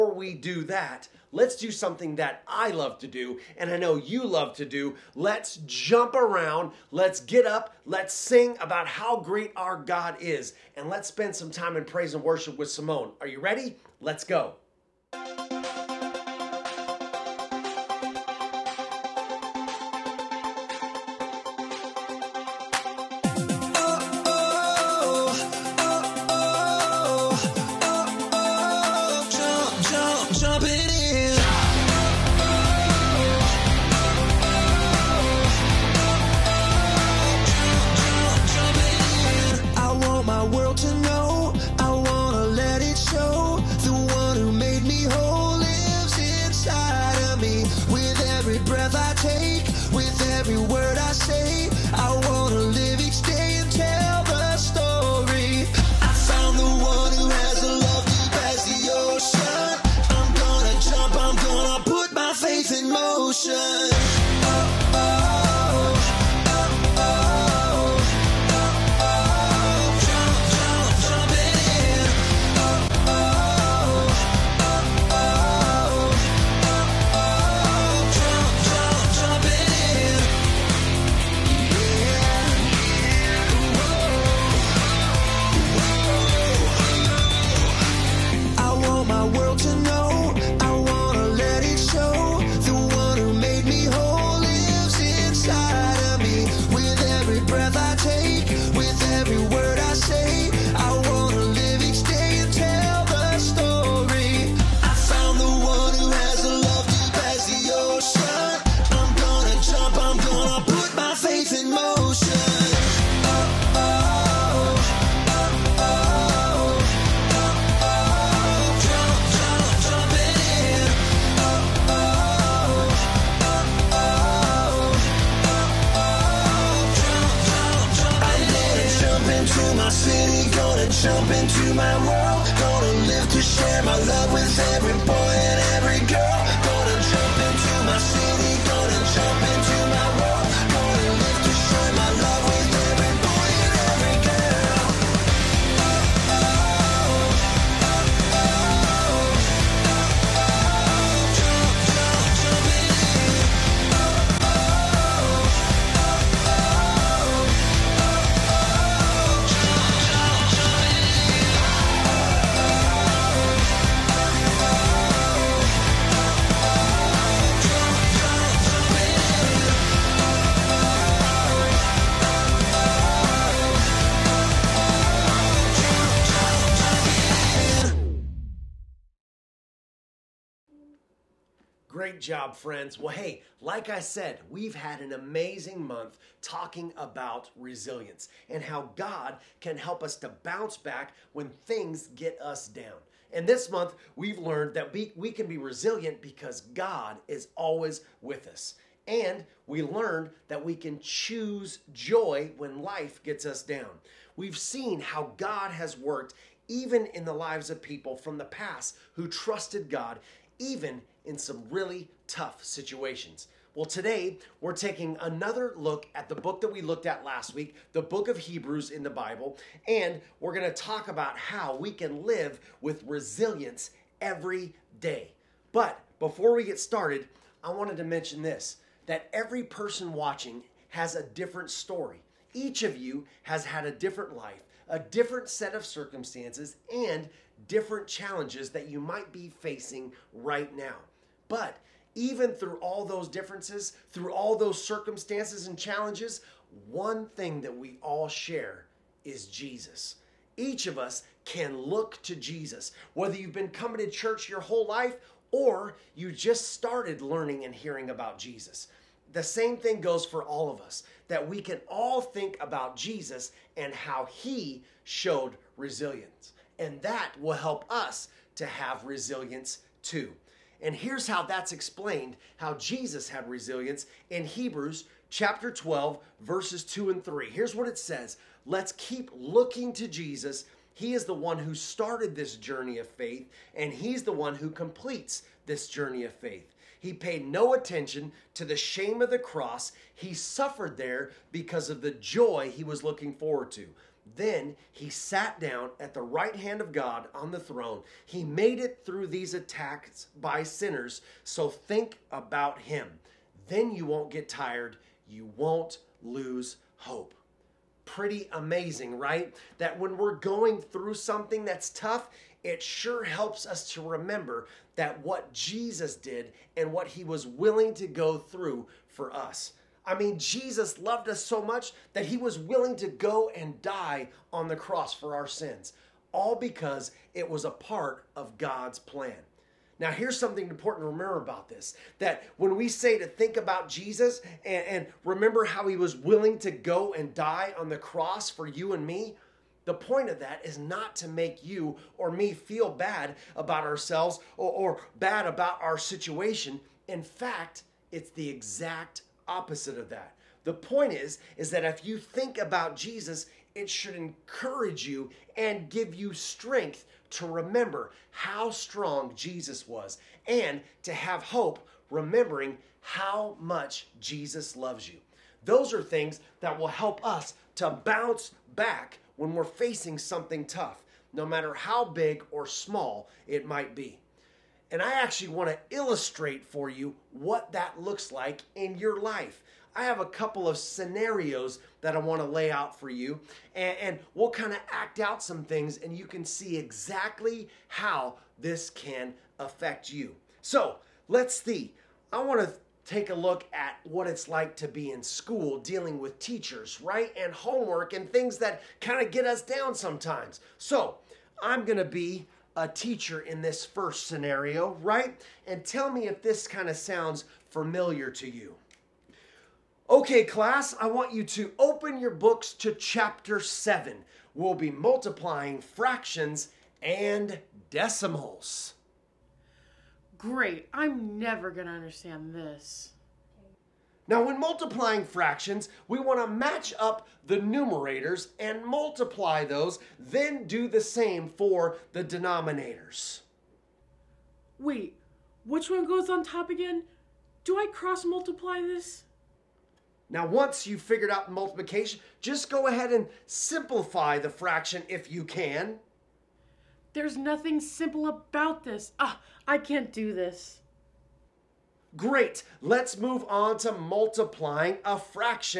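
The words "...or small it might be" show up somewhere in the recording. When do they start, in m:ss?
6:12.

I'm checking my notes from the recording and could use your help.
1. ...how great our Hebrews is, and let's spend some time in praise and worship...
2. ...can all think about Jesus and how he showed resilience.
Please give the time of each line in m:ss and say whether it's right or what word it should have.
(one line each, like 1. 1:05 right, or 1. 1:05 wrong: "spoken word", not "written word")
1. 0:08 wrong: "God", not "Hebrews"
2. 4:21 right.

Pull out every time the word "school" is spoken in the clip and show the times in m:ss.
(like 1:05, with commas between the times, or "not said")
6:35.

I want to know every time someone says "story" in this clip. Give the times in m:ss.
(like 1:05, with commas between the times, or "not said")
3:51.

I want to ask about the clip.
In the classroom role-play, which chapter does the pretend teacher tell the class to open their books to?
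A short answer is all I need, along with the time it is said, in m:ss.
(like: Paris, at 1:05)
7, at 6:52.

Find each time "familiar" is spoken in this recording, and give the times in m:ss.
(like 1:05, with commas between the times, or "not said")
6:47.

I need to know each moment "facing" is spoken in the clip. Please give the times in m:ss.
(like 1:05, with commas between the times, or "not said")
3:59, 6:09.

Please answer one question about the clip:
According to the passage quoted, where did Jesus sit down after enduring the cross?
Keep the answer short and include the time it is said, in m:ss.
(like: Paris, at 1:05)
The right hand of God, at 4:56.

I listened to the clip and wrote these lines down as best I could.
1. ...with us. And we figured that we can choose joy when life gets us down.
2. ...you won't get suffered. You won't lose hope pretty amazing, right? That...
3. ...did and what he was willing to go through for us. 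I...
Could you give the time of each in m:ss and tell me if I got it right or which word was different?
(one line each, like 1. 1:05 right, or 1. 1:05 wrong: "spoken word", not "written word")
1. 3:18 wrong: "learned", not "figured"
2. 5:03 wrong: "tired", not "suffered"
3. 5:16 right.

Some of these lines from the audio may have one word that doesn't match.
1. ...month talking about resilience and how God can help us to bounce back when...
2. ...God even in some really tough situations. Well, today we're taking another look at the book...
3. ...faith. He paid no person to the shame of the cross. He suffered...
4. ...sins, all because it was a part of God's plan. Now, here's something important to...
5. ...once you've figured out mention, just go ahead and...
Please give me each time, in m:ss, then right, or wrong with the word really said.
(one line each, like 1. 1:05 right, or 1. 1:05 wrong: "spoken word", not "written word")
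1. 3:05 right
2. 3:29 right
3. 4:46 wrong: "attention", not "person"
4. 5:25 right
5. 7:20 wrong: "multiplication", not "mention".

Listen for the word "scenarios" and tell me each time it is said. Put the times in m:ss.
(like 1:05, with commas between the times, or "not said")
6:20, 6:44.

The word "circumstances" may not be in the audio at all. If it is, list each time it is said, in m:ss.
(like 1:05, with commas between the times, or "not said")
3:55, 4:04.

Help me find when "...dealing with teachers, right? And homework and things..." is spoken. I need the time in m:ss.
6:35.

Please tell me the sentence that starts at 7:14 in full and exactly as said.
Wait, which one goes on top again?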